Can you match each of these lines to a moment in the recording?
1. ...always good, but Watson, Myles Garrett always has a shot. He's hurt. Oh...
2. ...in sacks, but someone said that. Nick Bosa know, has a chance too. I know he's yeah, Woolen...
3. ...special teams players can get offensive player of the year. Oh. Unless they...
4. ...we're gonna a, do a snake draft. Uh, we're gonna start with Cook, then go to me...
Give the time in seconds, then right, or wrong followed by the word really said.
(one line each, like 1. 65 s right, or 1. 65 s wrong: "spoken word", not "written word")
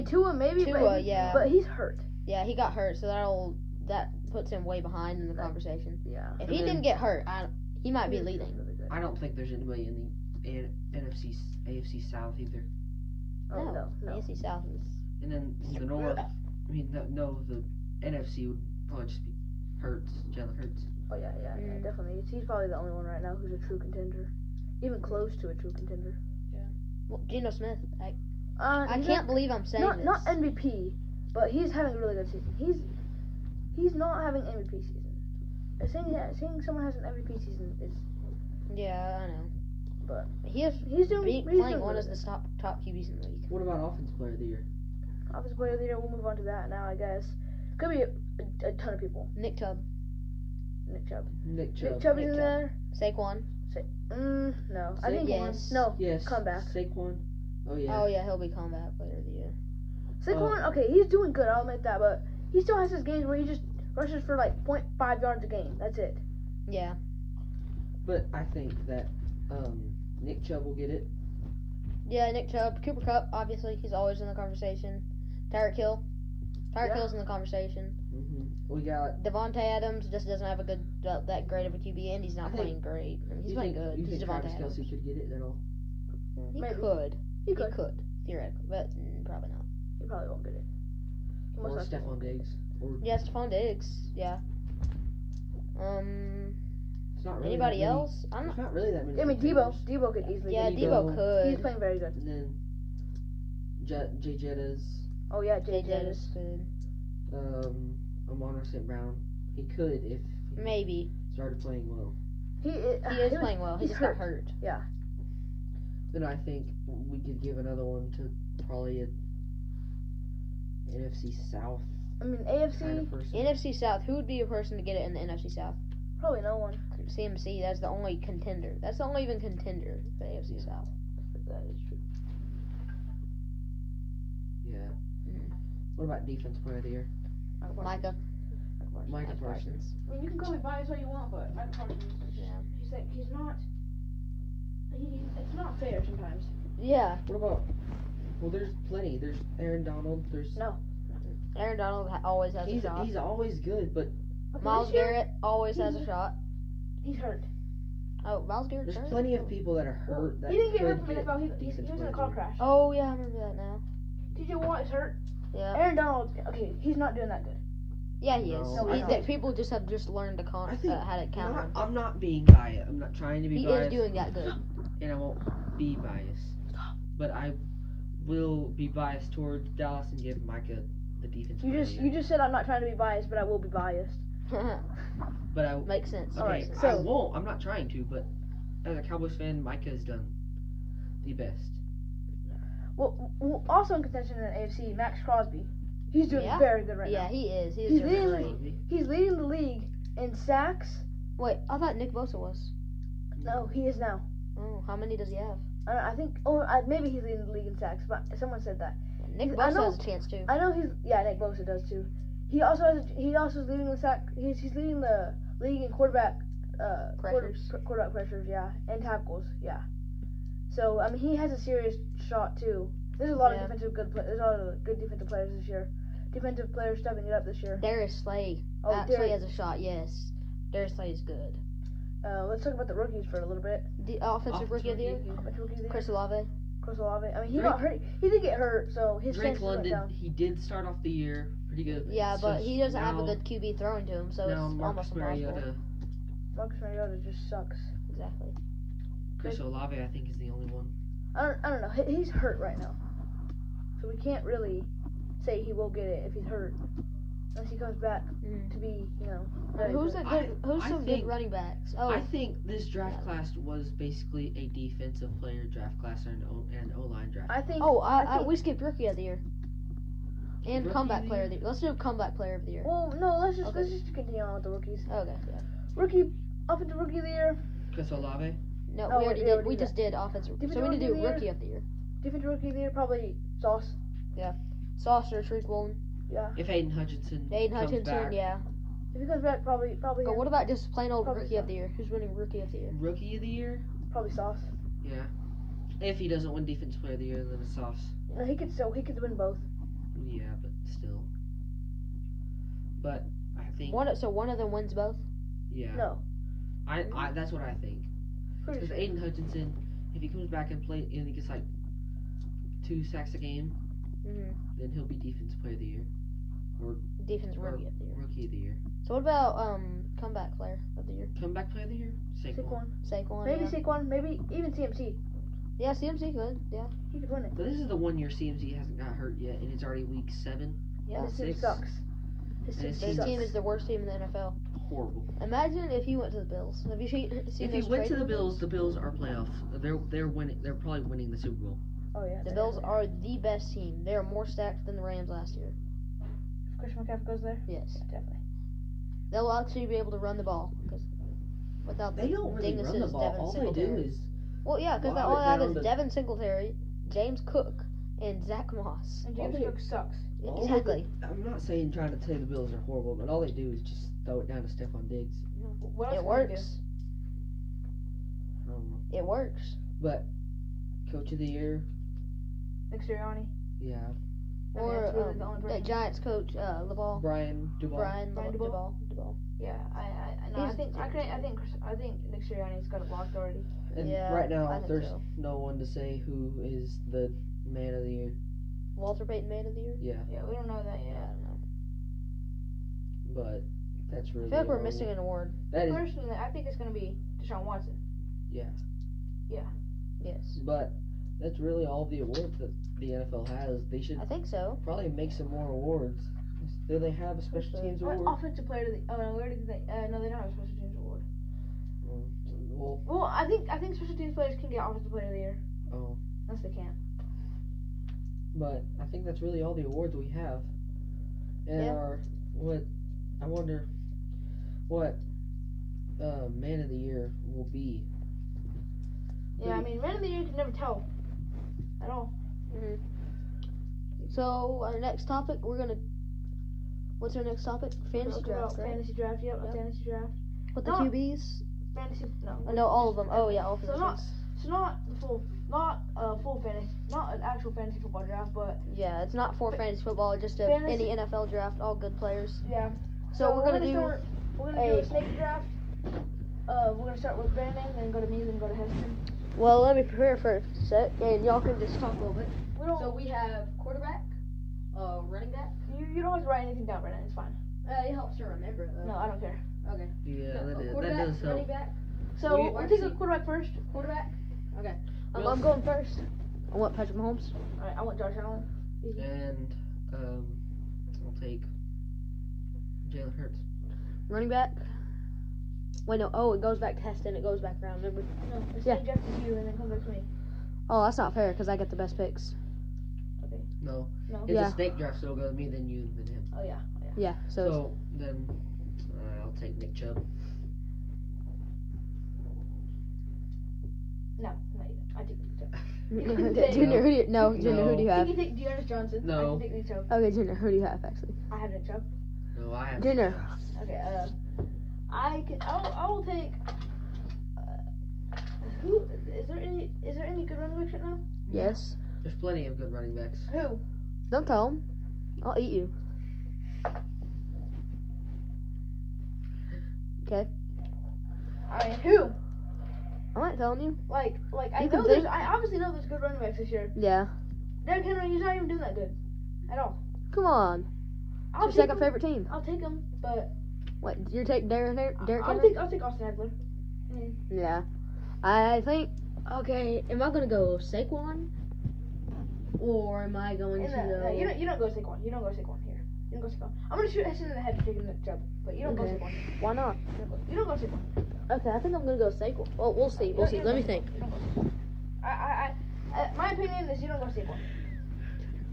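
1. 153 s wrong: "Okay", not "Watson"
2. 207 s wrong: "Nick", not "Woolen"
3. 413 s right
4. 454 s wrong: "Brandon", not "Cook".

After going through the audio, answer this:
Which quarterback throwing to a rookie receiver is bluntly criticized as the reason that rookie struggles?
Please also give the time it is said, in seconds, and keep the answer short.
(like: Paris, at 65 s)
Marcus Mariota, at 246 s.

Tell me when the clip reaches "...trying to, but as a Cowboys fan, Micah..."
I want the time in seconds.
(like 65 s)
187 s.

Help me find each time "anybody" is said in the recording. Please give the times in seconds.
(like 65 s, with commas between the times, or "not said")
9 s, 97 s.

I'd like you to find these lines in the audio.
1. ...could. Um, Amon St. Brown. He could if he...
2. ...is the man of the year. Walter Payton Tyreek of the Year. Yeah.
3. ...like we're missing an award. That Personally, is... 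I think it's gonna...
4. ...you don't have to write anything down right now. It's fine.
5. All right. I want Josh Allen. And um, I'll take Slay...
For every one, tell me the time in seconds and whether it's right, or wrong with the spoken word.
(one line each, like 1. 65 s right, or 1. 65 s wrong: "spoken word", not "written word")
1. 106 s right
2. 386 s wrong: "Man", not "Tyreek"
3. 394 s right
4. 466 s right
5. 477 s wrong: "Jalen", not "Slay".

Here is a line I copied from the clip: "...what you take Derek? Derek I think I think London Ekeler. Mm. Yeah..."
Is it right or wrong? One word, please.
wrong.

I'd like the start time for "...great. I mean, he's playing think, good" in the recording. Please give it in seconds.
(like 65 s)
82 s.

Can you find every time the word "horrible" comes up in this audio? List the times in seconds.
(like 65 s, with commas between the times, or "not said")
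334 s, 362 s.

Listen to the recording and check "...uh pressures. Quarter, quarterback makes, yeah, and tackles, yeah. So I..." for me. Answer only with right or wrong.
wrong.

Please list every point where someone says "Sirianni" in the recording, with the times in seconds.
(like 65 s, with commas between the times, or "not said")
373 s, 382 s.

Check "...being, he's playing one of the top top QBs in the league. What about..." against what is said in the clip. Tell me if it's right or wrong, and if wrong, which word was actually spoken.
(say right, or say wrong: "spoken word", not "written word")
right.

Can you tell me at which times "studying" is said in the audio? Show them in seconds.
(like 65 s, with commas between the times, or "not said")
not said.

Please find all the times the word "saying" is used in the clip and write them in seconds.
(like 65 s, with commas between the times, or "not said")
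29 s, 35 s, 361 s.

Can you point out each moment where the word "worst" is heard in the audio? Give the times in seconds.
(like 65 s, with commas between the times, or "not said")
333 s.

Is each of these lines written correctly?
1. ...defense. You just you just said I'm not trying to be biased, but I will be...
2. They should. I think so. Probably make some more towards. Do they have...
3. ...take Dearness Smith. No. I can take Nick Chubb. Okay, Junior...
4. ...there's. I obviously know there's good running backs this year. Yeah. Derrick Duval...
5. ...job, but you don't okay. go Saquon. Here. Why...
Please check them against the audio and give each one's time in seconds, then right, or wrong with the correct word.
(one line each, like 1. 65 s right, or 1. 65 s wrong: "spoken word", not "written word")
1. 181 s right
2. 403 s wrong: "awards", not "towards"
3. 508 s wrong: "Johnson", not "Smith"
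4. 535 s wrong: "Henry", not "Duval"
5. 558 s right.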